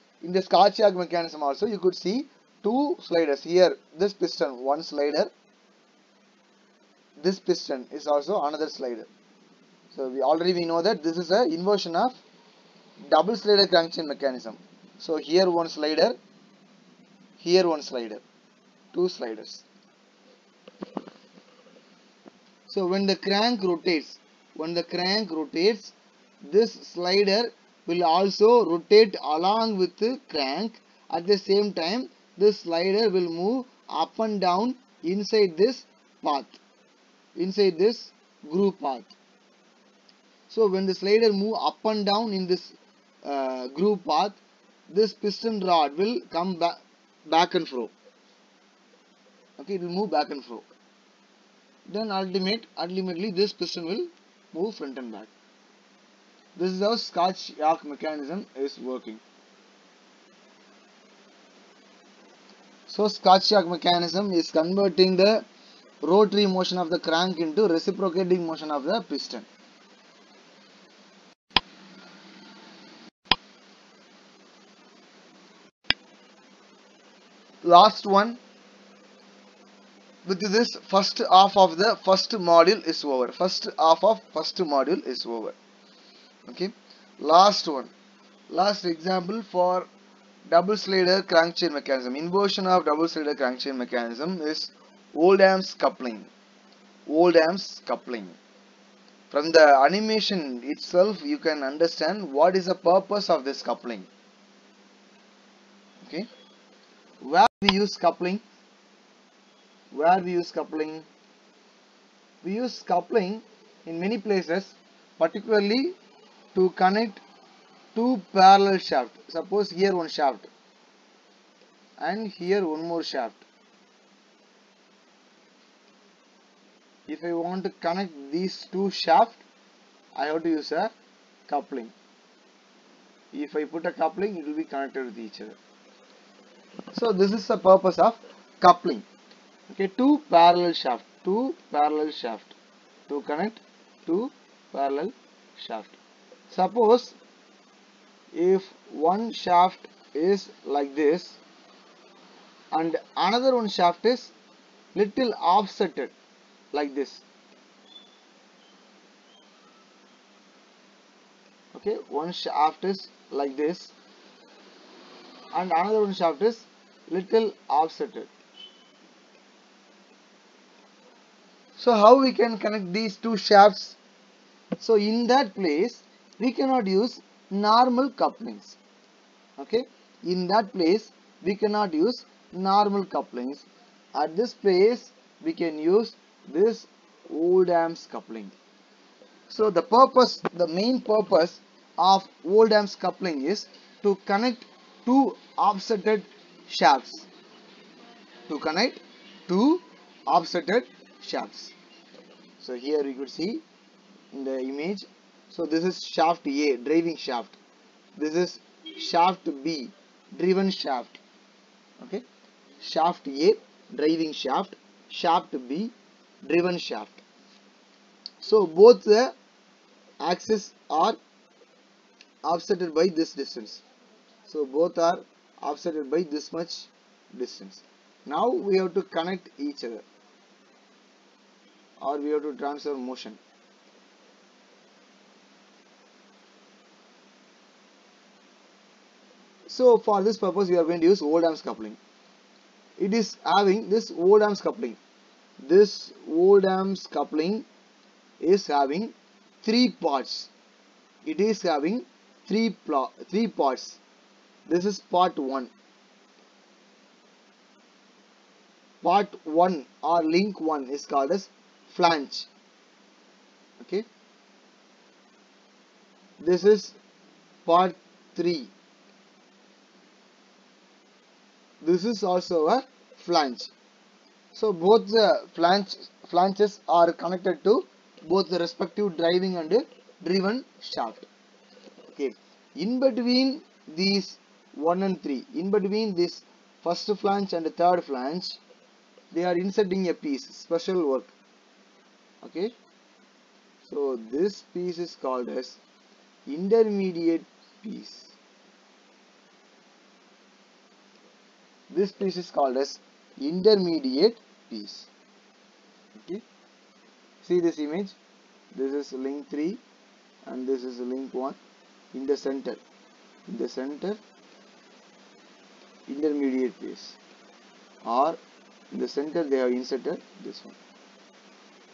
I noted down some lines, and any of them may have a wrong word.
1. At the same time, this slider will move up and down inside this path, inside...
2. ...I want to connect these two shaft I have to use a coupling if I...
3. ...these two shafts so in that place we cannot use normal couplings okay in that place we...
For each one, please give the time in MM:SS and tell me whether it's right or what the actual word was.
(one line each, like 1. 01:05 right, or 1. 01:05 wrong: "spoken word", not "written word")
1. 00:31 right
2. 02:07 right
3. 02:52 right.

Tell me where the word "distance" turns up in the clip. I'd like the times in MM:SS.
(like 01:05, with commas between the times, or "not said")
03:43, 03:47.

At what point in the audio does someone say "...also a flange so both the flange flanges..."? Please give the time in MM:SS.
04:32.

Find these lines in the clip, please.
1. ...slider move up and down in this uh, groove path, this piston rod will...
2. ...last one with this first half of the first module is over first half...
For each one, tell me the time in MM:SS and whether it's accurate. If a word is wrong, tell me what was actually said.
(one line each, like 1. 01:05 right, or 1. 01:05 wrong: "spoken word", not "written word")
1. 00:41 right
2. 01:17 right.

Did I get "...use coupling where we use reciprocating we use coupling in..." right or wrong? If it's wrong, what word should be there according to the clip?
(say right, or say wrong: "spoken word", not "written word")
wrong: "coupling", not "reciprocating".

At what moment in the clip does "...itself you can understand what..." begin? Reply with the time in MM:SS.
01:40.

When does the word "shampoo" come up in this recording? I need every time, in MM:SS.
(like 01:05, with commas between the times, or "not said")
not said.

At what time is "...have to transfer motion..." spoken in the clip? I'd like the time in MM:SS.
03:52.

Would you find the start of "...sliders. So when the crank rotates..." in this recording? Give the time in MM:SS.
00:19.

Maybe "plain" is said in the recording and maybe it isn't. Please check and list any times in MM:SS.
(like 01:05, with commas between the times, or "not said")
not said.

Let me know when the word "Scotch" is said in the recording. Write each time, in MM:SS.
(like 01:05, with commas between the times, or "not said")
00:00, 00:57, 01:03.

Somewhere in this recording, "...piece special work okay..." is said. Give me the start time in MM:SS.
04:50.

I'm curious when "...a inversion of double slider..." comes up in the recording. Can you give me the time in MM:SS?
00:11.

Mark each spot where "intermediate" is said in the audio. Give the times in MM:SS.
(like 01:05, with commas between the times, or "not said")
04:56, 05:03, 05:16.